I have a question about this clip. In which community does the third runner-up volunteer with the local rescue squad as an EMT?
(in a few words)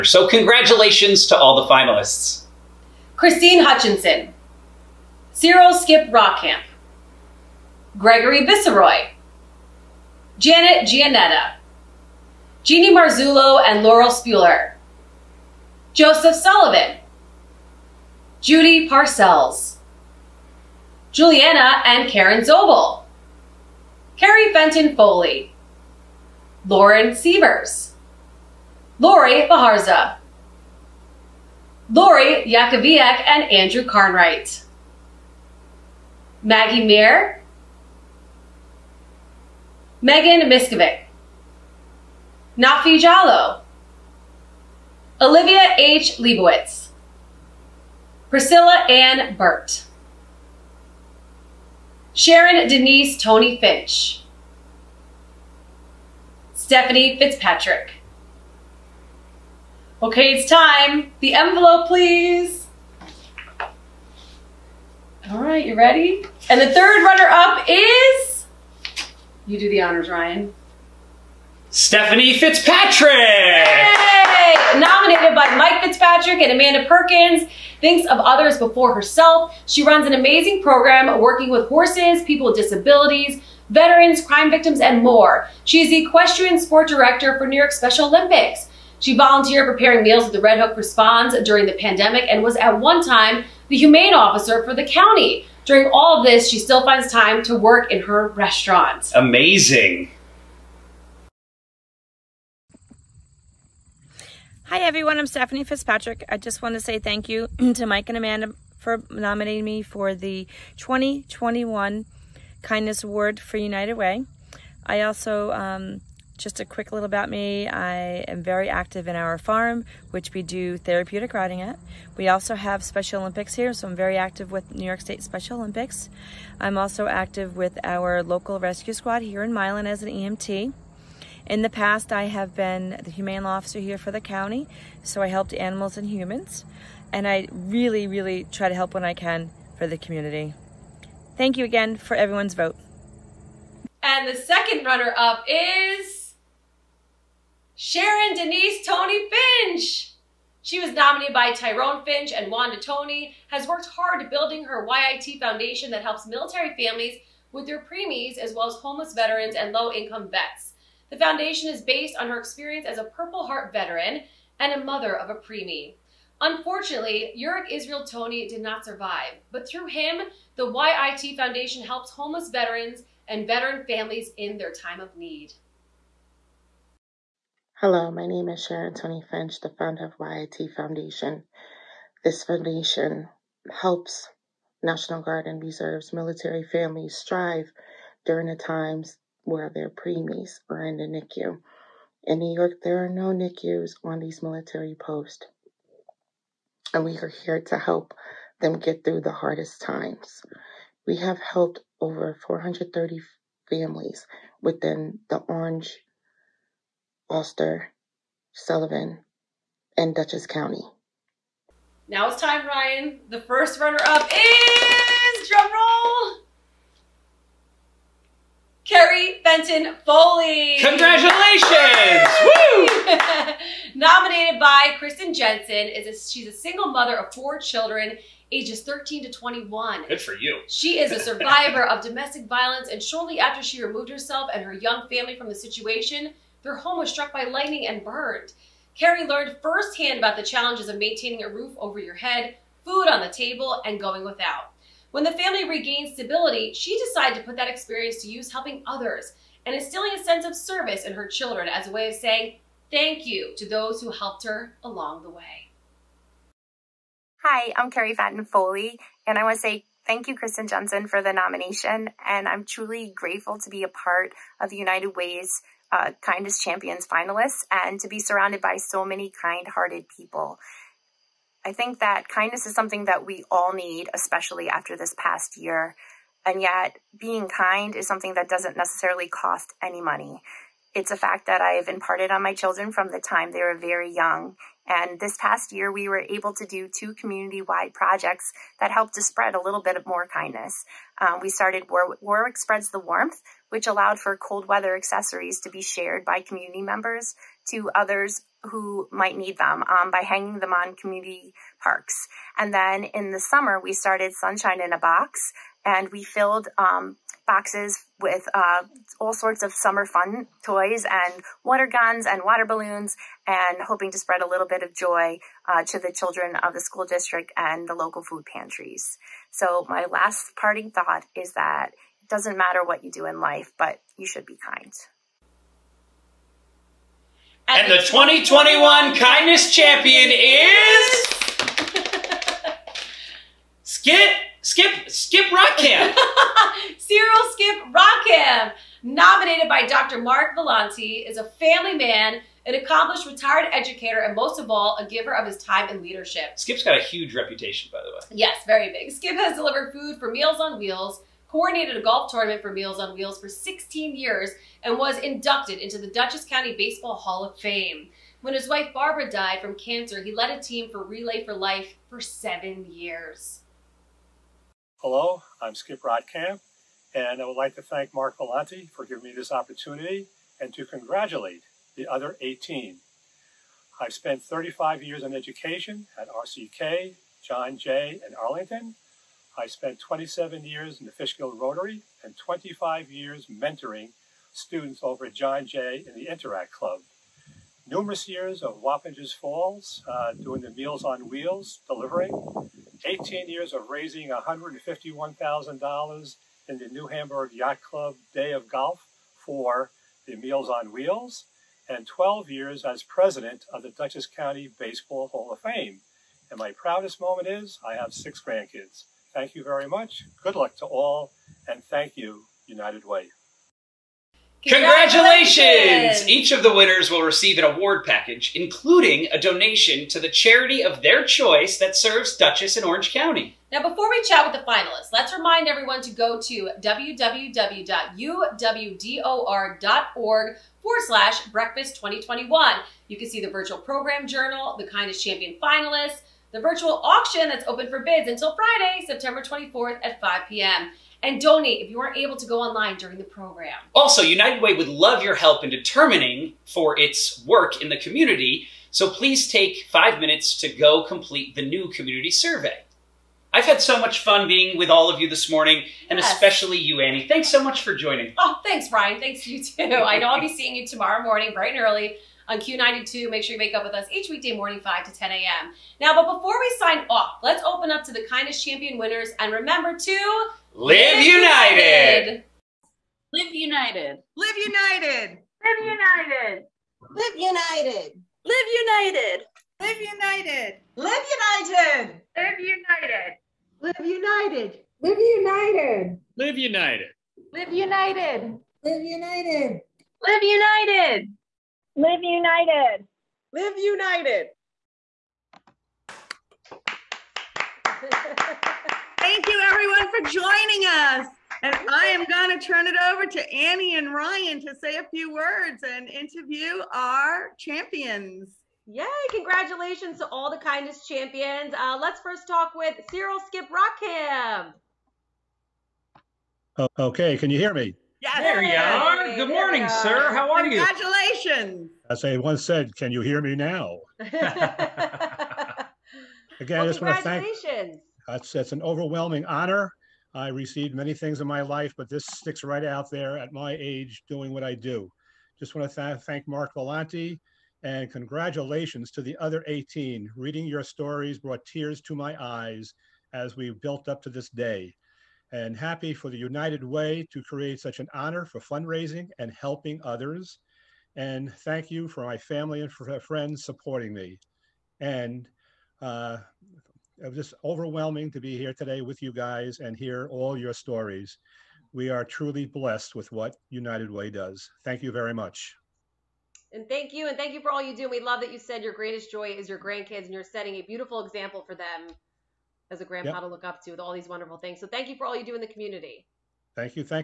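Milan.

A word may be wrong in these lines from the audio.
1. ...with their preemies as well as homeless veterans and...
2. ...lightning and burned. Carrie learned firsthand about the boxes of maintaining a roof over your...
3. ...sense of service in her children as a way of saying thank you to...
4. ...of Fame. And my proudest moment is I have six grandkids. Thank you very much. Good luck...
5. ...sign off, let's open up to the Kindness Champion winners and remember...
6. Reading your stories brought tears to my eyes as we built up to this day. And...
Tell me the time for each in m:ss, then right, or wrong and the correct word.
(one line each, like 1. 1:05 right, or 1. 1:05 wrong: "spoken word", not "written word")
1. 2:37 right
2. 3:57 wrong: "challenges", not "boxes"
3. 4:10 right
4. 6:45 right
5. 7:46 right
6. 9:00 right.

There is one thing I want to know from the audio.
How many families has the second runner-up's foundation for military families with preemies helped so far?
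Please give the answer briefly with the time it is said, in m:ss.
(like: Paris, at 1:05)
430, at 3:22.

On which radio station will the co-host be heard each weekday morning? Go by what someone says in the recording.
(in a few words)
Q92.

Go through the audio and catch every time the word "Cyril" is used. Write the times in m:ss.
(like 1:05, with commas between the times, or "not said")
0:05, 5:36, 8:33.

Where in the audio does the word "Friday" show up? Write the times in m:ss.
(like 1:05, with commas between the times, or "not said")
7:18.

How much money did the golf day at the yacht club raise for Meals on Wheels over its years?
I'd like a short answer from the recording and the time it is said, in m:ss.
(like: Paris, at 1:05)
$151,000, at 6:34.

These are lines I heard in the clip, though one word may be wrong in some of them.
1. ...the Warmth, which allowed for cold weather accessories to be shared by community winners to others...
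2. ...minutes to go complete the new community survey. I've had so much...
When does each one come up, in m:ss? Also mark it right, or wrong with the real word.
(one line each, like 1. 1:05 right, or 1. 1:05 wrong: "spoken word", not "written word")
1. 4:52 wrong: "members", not "winners"
2. 7:30 right.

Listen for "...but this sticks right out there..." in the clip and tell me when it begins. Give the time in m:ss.
8:51.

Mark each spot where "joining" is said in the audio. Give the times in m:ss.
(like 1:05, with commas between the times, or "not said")
7:37, 8:20.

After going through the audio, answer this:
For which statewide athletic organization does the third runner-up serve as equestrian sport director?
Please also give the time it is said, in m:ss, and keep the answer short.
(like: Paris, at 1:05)
New York Special Olympics, at 1:27.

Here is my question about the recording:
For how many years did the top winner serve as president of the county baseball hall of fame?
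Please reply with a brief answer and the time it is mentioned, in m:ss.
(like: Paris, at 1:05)
12, at 6:42.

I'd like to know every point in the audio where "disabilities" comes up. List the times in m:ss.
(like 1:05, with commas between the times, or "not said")
1:22.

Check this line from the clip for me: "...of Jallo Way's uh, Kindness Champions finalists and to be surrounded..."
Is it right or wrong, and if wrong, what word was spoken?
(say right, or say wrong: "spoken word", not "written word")
wrong: "United", not "Jallo".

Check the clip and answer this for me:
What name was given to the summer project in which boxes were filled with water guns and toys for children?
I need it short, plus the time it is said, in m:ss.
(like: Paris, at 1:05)
Sunshine in a Box, at 5:04.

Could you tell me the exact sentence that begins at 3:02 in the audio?
This foundation helps National Guard and Reserves military families strive during the times where their preemies are in the NICU.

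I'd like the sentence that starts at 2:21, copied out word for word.
Thank you again for everyone's vote.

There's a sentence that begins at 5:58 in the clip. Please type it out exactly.
When his wife Barbara died from cancer, he led a team for Relay for Life for seven years.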